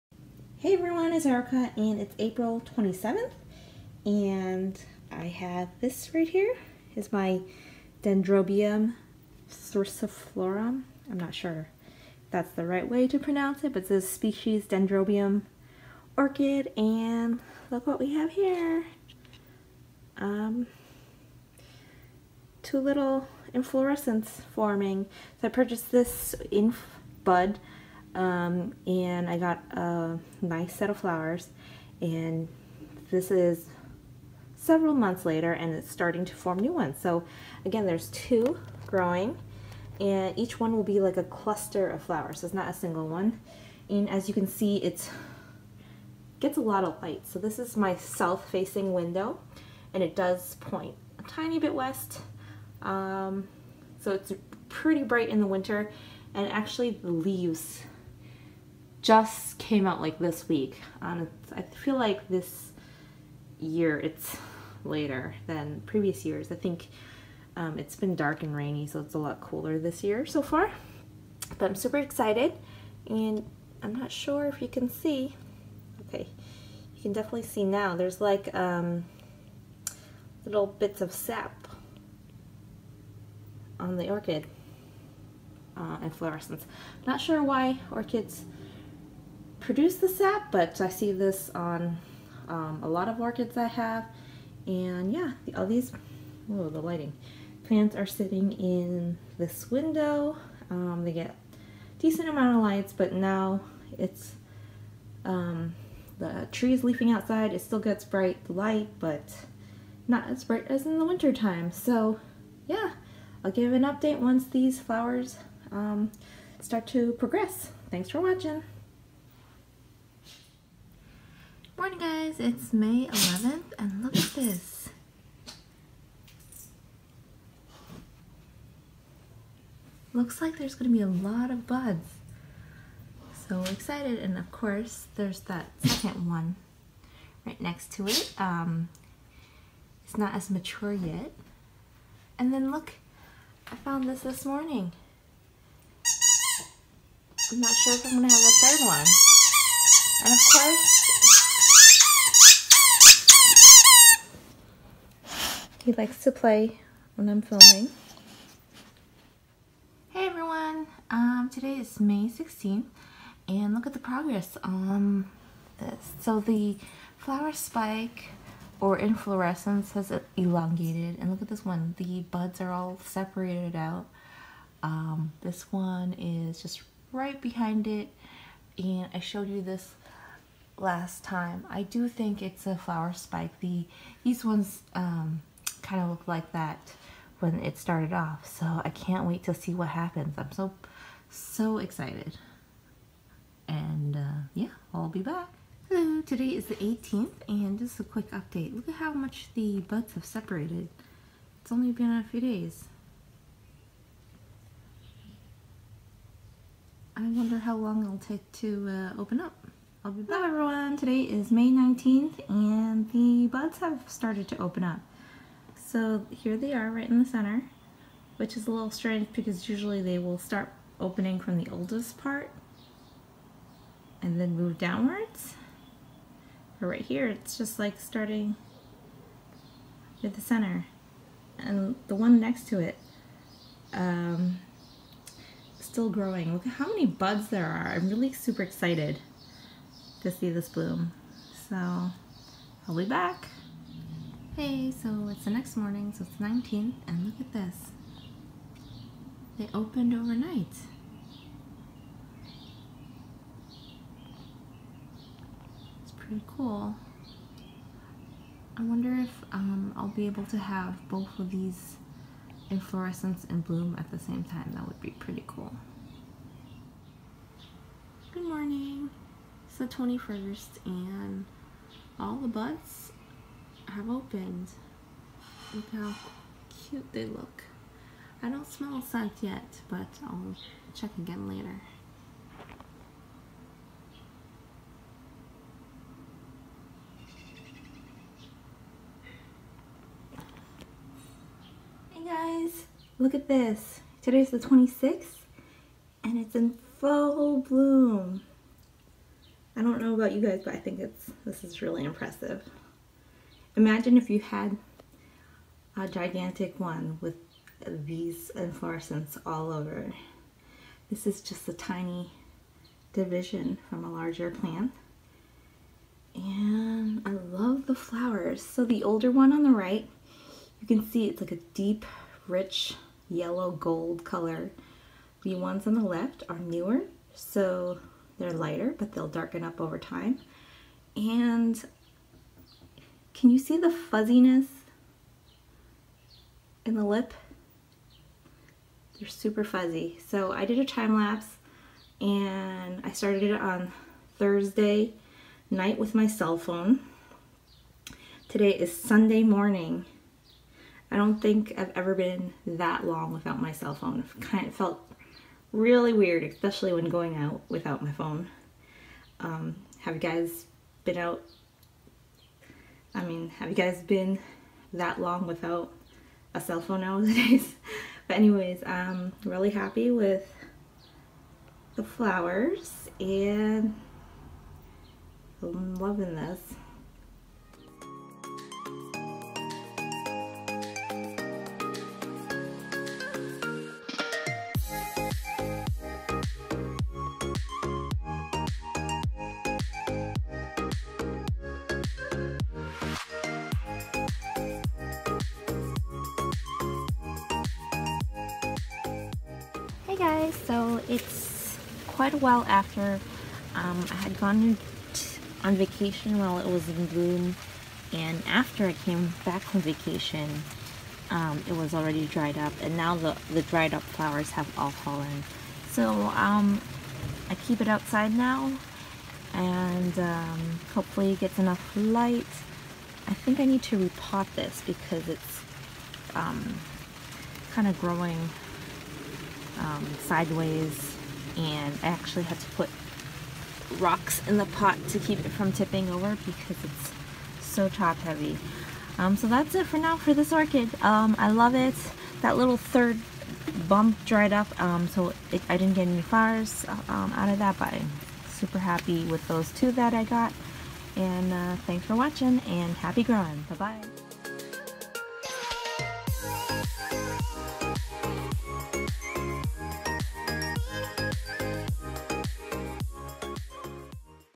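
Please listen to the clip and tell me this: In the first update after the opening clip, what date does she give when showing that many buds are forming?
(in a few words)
May 11th.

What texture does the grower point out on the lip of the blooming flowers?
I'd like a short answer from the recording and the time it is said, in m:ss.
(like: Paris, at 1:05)
Fuzzy, at 5:39.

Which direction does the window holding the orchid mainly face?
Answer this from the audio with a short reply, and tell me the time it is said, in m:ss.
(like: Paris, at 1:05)
South, at 0:47.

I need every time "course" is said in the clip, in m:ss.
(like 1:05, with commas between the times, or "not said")
2:14, 2:30.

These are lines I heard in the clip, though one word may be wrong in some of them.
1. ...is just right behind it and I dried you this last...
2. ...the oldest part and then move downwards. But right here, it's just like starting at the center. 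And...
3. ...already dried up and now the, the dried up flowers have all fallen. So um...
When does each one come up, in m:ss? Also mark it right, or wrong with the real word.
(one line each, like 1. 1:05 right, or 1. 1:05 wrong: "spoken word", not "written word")
1. 2:56 wrong: "showed", not "dried"
2. 3:41 right
3. 6:51 right.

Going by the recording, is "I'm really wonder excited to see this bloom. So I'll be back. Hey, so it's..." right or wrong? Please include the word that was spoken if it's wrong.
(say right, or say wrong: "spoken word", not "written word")
wrong: "super", not "wonder".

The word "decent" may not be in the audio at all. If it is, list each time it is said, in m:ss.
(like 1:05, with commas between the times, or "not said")
1:41.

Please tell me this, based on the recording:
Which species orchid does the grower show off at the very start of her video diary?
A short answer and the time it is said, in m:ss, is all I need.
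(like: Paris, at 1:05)
Dendrobium thyrsiflorum, at 0:08.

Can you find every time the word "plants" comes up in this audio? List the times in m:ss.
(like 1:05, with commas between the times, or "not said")
1:37, 5:14.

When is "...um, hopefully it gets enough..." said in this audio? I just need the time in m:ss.
7:00.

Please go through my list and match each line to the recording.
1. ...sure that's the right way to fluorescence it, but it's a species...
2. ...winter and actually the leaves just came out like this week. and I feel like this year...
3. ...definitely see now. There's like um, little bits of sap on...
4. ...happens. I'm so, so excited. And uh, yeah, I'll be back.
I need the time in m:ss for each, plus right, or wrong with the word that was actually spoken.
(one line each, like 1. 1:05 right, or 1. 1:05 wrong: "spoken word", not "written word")
1. 0:11 wrong: "pronounce", not "fluorescence"
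2. 0:55 right
3. 1:17 right
4. 3:09 right.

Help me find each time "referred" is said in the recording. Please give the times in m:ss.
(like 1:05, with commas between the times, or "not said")
not said.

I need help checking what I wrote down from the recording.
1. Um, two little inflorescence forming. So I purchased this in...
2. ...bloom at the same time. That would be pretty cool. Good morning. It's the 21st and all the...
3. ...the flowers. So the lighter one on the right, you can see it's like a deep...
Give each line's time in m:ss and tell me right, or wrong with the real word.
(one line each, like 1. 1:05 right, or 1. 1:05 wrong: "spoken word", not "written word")
1. 0:20 right
2. 4:23 right
3. 5:17 wrong: "older", not "lighter".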